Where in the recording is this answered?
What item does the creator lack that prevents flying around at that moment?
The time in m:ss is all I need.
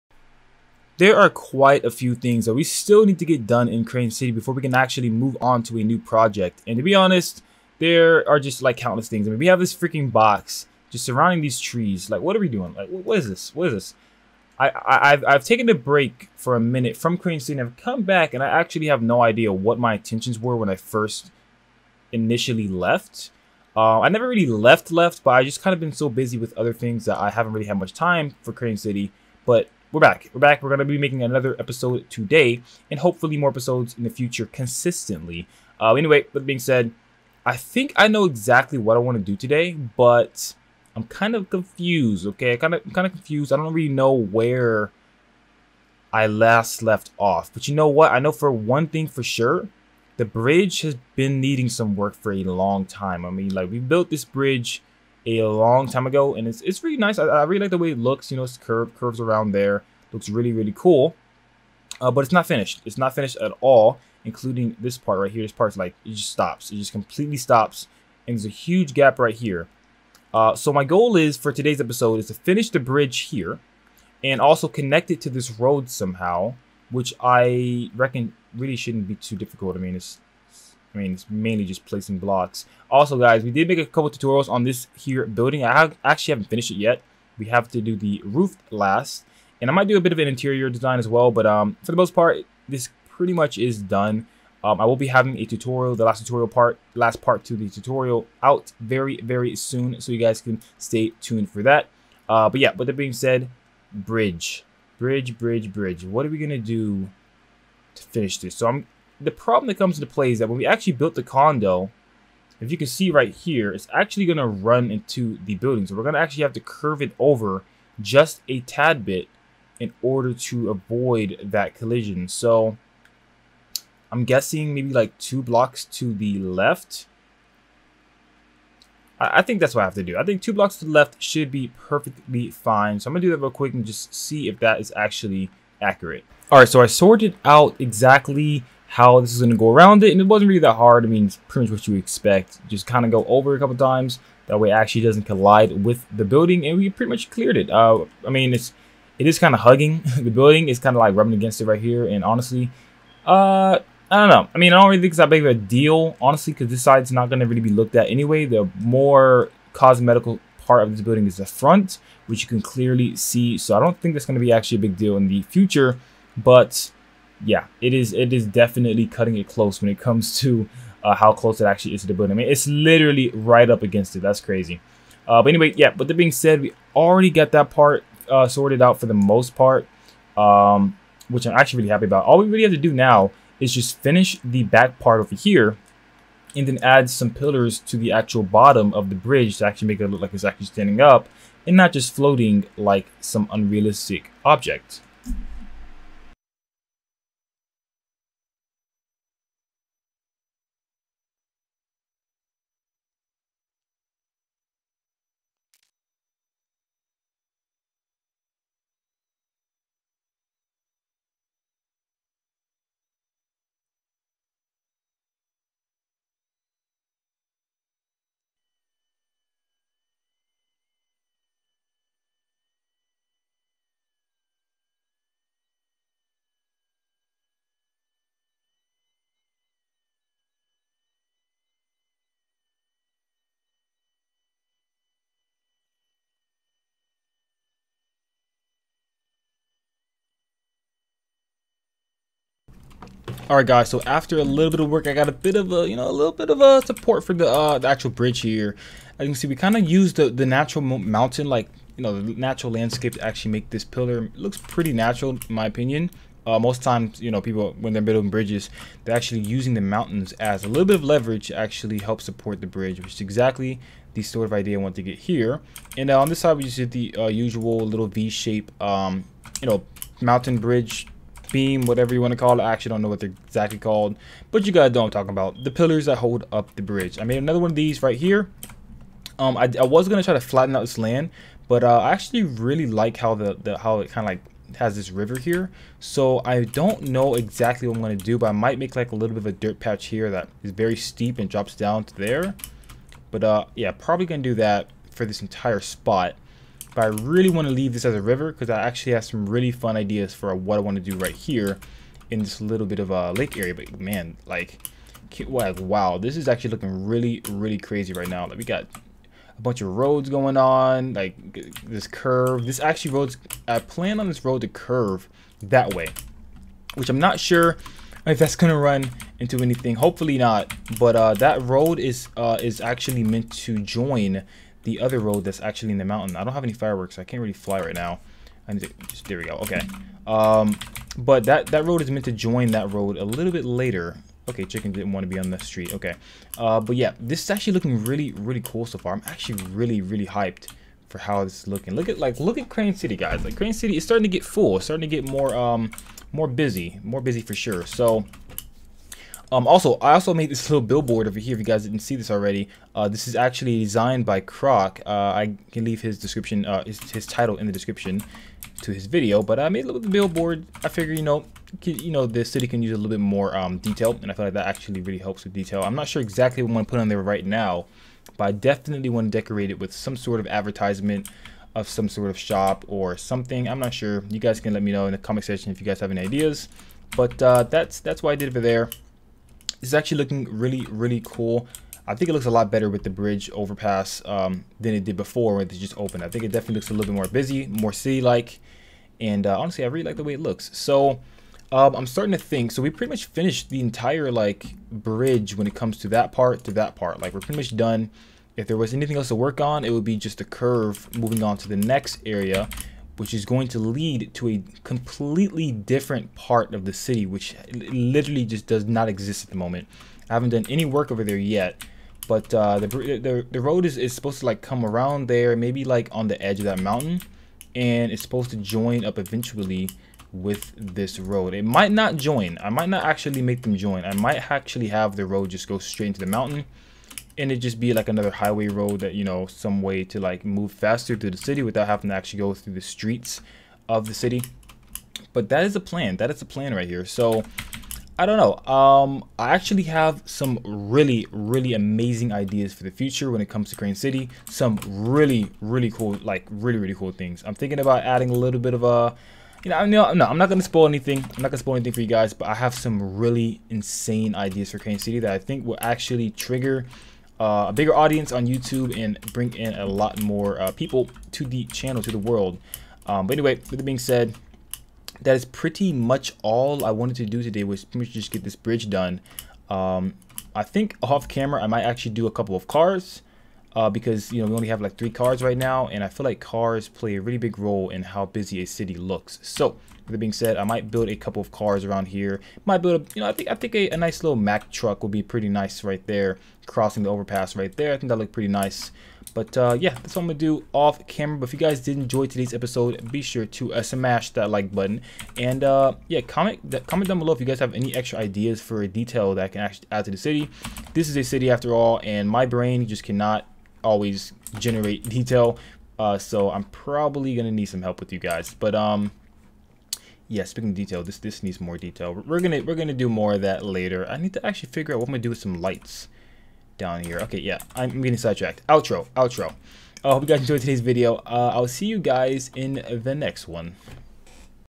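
5:26.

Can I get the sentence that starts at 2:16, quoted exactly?
All right, so I sorted out exactly how this is going to go around it.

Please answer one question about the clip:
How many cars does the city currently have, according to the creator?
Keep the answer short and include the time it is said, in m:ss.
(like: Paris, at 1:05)
3, at 7:54.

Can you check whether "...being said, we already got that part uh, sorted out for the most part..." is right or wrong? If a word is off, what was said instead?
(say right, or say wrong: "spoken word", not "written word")
right.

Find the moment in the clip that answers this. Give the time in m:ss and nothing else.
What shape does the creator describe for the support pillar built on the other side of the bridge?
4:28.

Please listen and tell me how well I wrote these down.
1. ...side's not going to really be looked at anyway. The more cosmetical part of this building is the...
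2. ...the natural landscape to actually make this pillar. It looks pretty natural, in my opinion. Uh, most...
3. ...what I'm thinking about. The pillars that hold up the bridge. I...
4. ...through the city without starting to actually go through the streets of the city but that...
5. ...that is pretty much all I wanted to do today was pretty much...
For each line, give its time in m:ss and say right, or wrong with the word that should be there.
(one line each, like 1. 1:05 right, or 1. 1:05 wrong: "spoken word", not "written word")
1. 2:36 right
2. 4:12 right
3. 4:35 wrong: "talking", not "thinking"
4. 7:11 wrong: "having", not "starting"
5. 7:45 right.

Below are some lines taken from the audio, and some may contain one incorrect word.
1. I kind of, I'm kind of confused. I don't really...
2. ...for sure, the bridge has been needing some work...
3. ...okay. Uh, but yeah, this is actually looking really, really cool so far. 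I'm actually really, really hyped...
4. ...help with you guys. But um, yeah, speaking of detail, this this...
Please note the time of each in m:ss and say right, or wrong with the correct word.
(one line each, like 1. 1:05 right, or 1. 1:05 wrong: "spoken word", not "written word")
1. 0:42 right
2. 0:49 right
3. 5:35 right
4. 8:27 right.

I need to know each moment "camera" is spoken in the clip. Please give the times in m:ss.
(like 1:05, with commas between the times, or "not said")
7:51, 8:11.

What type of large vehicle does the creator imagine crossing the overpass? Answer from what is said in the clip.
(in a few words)
Mack truck.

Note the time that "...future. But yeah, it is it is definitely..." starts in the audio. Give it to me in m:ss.
2:45.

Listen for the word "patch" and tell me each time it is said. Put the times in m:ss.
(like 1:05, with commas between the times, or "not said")
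4:49.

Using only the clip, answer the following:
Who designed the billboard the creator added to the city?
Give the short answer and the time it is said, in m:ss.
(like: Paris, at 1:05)
Croc, at 5:54.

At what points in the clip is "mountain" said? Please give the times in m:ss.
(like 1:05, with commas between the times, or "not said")
4:10, 4:19, 4:30, 5:26, 6:56, 7:06.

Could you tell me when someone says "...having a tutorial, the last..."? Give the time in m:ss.
1:35.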